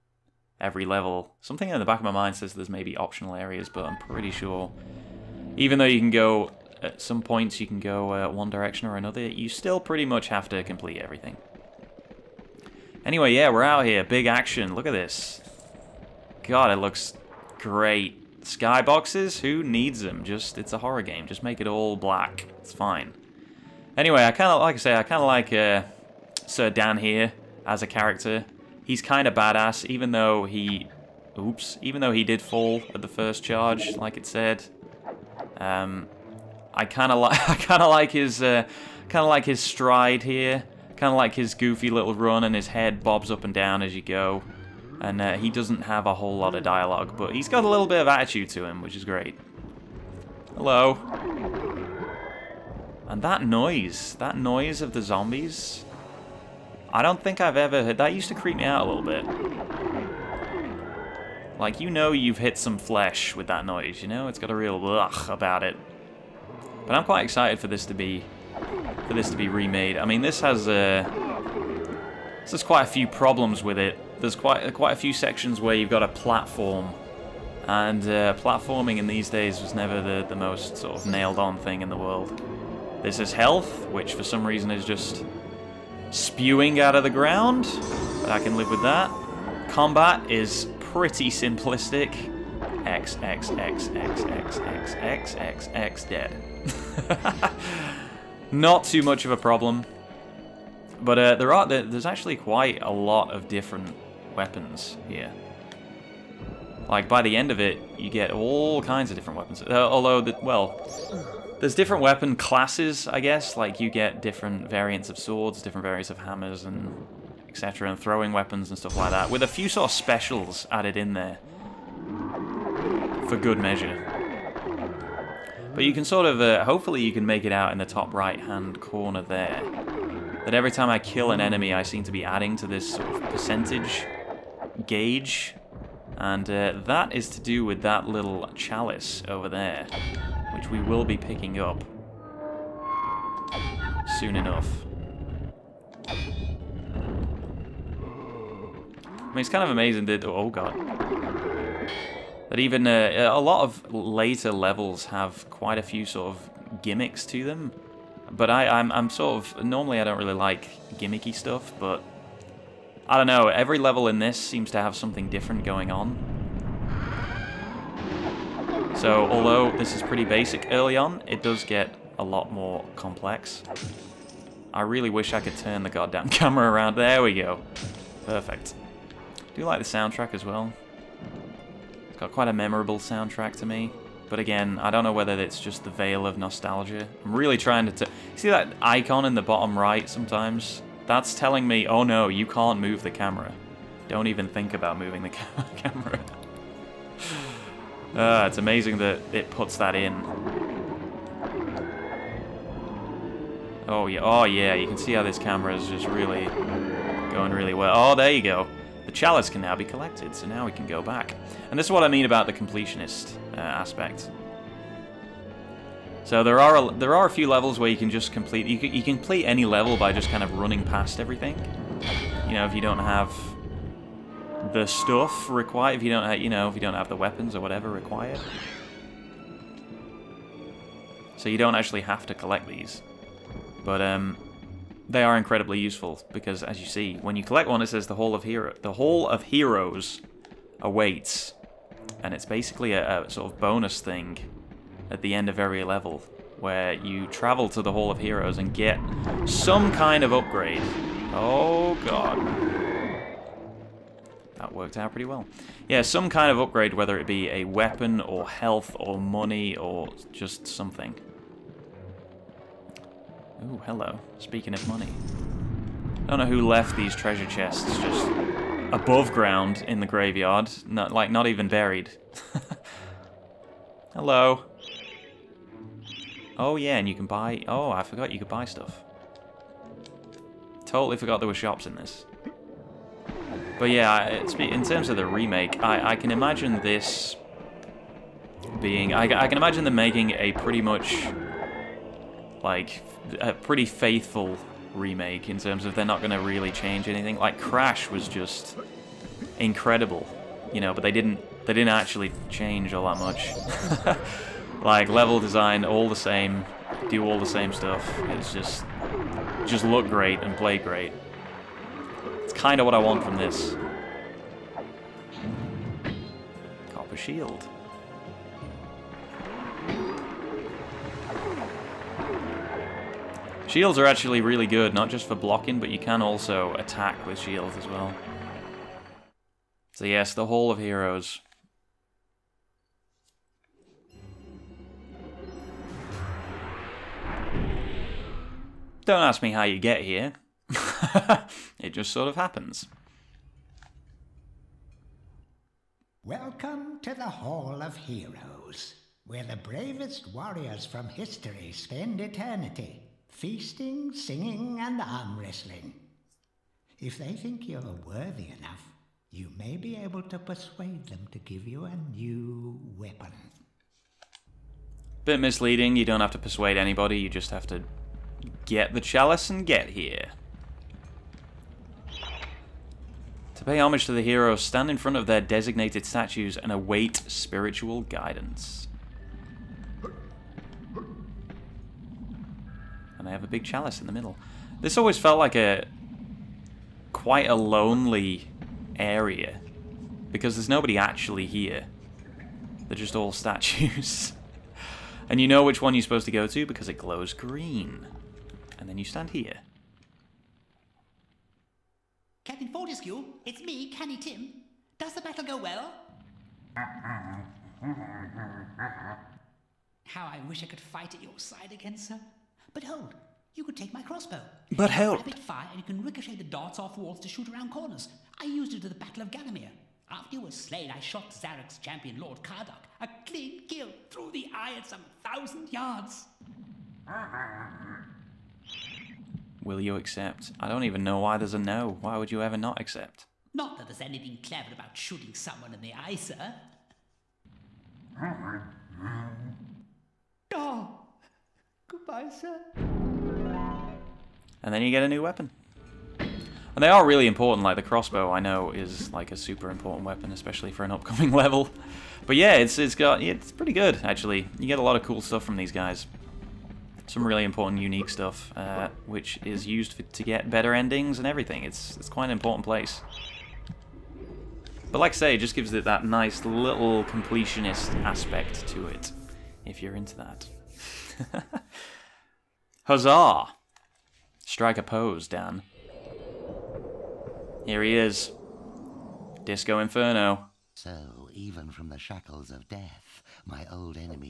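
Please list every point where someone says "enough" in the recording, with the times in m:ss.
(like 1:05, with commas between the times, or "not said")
2:24, 5:58.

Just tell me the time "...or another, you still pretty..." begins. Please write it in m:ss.
0:08.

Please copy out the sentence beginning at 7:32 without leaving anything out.
But yeah, it's it's got it's pretty good actually.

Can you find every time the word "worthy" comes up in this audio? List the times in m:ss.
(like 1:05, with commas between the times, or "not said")
5:58.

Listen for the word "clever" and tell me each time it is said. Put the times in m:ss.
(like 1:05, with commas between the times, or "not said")
7:14.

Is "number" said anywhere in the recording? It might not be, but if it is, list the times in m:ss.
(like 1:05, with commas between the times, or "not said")
not said.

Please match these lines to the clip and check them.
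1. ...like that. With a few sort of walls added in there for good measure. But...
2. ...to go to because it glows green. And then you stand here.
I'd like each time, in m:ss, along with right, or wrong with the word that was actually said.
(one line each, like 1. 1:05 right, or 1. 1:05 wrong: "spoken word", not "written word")
1. 1:58 wrong: "specials", not "walls"
2. 6:36 right.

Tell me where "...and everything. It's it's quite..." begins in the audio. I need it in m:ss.
7:41.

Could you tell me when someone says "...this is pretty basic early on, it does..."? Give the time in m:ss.
2:49.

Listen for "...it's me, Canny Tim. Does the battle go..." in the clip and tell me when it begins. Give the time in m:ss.
6:43.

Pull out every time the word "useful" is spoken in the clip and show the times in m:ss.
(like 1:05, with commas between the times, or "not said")
3:55.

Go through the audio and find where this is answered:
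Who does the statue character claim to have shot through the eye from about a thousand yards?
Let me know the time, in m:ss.
7:02.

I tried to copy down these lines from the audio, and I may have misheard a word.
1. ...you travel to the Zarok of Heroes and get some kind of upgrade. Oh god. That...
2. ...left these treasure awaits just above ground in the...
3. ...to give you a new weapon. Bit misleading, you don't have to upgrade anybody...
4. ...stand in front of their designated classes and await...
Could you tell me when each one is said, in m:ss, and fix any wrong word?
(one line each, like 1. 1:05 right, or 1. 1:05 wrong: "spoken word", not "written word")
1. 4:06 wrong: "Hall", not "Zarok"
2. 4:26 wrong: "chests", not "awaits"
3. 6:01 wrong: "persuade", not "upgrade"
4. 6:14 wrong: "statues", not "classes".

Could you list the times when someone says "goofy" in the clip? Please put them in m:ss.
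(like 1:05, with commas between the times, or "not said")
0:41.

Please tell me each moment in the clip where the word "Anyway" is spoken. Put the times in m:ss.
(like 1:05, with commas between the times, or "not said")
0:13, 0:23.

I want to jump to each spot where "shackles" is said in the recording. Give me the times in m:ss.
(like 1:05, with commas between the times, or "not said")
8:01.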